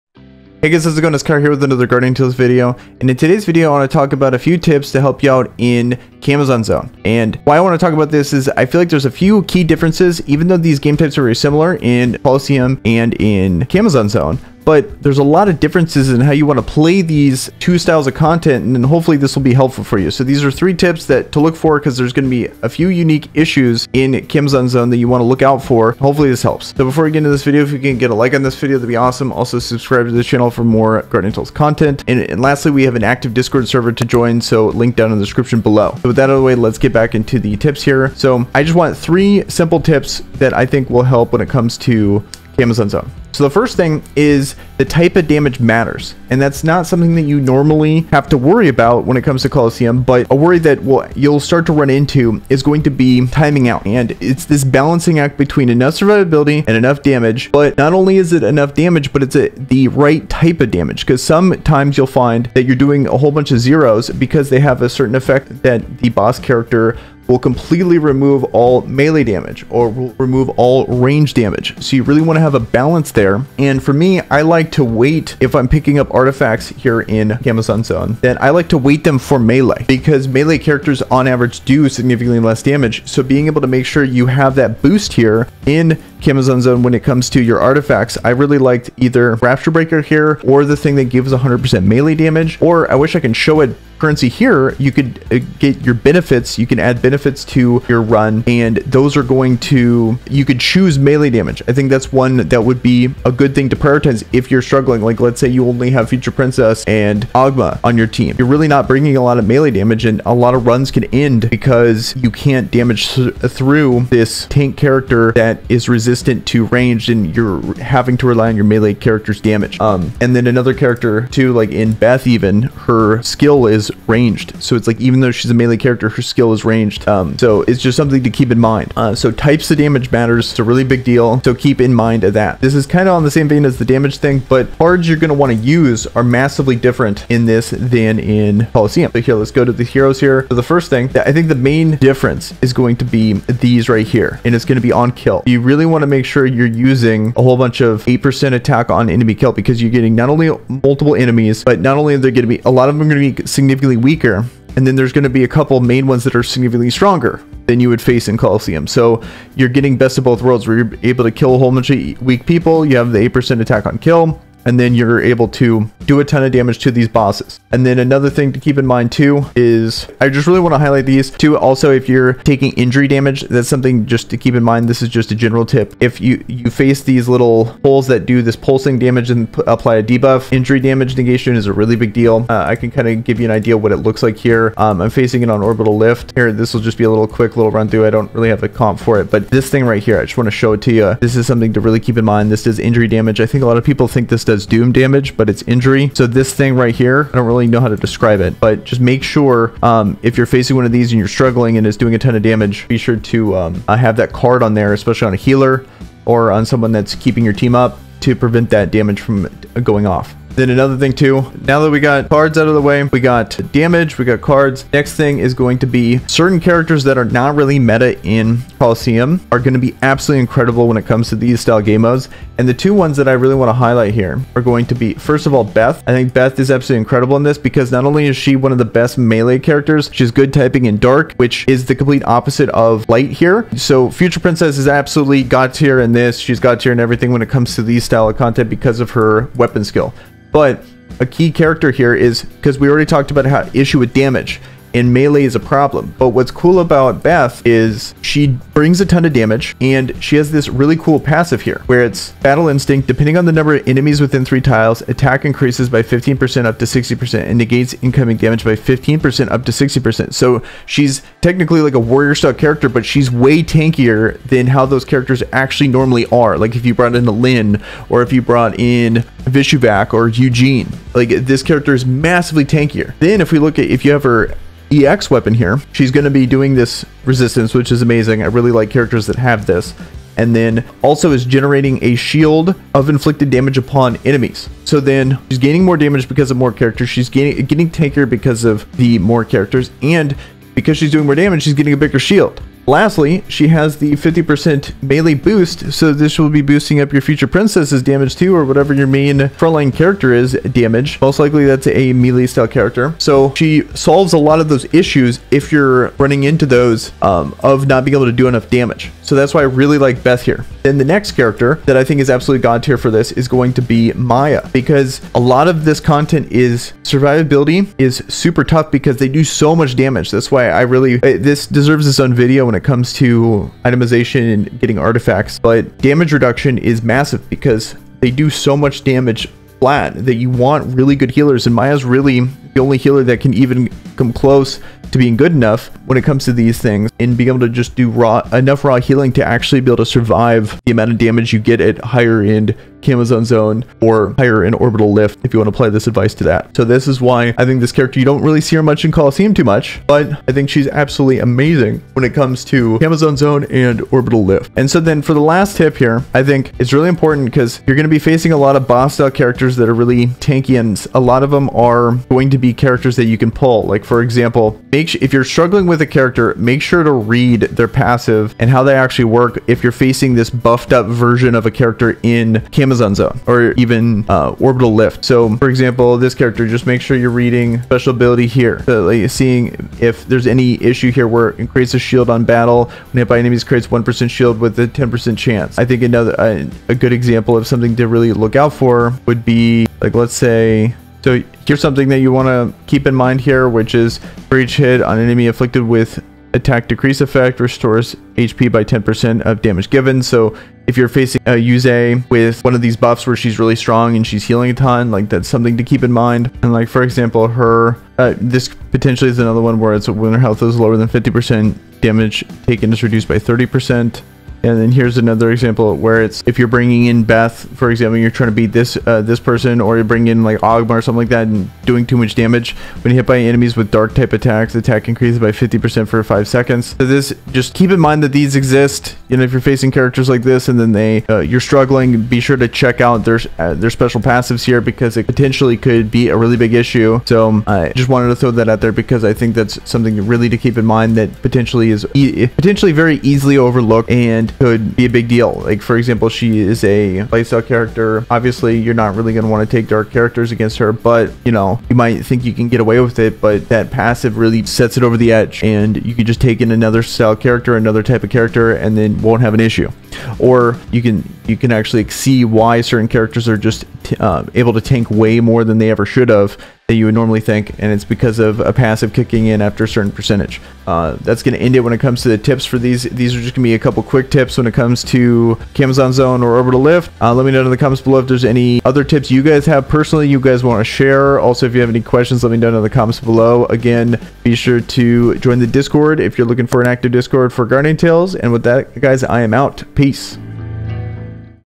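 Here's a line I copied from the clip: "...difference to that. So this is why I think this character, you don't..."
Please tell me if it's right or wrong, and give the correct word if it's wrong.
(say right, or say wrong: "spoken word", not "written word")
wrong: "advice", not "difference".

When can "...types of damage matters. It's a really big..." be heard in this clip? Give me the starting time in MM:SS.
02:09.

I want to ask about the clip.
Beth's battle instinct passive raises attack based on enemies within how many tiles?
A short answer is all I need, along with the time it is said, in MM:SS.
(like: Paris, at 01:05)
3, at 04:14.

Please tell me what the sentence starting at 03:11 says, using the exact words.
This is something to really keep in mind.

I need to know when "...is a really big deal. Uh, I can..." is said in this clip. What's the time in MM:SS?
03:01.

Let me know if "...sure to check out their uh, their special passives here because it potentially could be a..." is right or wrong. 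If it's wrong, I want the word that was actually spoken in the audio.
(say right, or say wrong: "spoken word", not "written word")
right.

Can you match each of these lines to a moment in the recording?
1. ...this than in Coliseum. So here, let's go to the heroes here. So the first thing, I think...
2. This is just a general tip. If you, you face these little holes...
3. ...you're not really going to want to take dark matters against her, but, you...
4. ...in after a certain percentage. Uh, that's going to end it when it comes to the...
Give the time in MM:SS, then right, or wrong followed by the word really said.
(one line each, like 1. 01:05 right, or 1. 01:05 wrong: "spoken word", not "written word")
1. 02:17 right
2. 02:54 right
3. 07:28 wrong: "characters", not "matters"
4. 07:49 right.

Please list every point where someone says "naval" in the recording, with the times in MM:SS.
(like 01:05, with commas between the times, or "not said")
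not said.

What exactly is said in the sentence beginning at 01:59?
Um, and then another character, too, like in Beth, even, her skill is ranged.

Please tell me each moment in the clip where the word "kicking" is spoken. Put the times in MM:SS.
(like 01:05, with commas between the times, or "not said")
07:49.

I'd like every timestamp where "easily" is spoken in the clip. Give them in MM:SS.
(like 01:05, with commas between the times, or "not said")
07:23.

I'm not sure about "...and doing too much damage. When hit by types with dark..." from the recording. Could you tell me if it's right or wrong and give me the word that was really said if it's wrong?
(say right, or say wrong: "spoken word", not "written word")
wrong: "enemies", not "types".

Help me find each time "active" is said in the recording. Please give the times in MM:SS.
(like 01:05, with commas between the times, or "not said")
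00:33, 08:06.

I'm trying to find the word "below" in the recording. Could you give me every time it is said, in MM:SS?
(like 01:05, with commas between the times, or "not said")
00:35, 07:58, 08:03.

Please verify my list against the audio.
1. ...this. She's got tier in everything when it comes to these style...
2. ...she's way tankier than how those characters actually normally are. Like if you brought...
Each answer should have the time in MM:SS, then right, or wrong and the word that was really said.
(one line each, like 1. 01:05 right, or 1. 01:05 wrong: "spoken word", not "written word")
1. 03:56 right
2. 04:23 right.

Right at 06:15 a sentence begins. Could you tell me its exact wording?
So for example, this character, just make sure you're reading special ability here.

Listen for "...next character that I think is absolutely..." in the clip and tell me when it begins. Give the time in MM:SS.
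05:11.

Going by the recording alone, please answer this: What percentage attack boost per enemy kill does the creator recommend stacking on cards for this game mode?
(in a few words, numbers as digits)
8%.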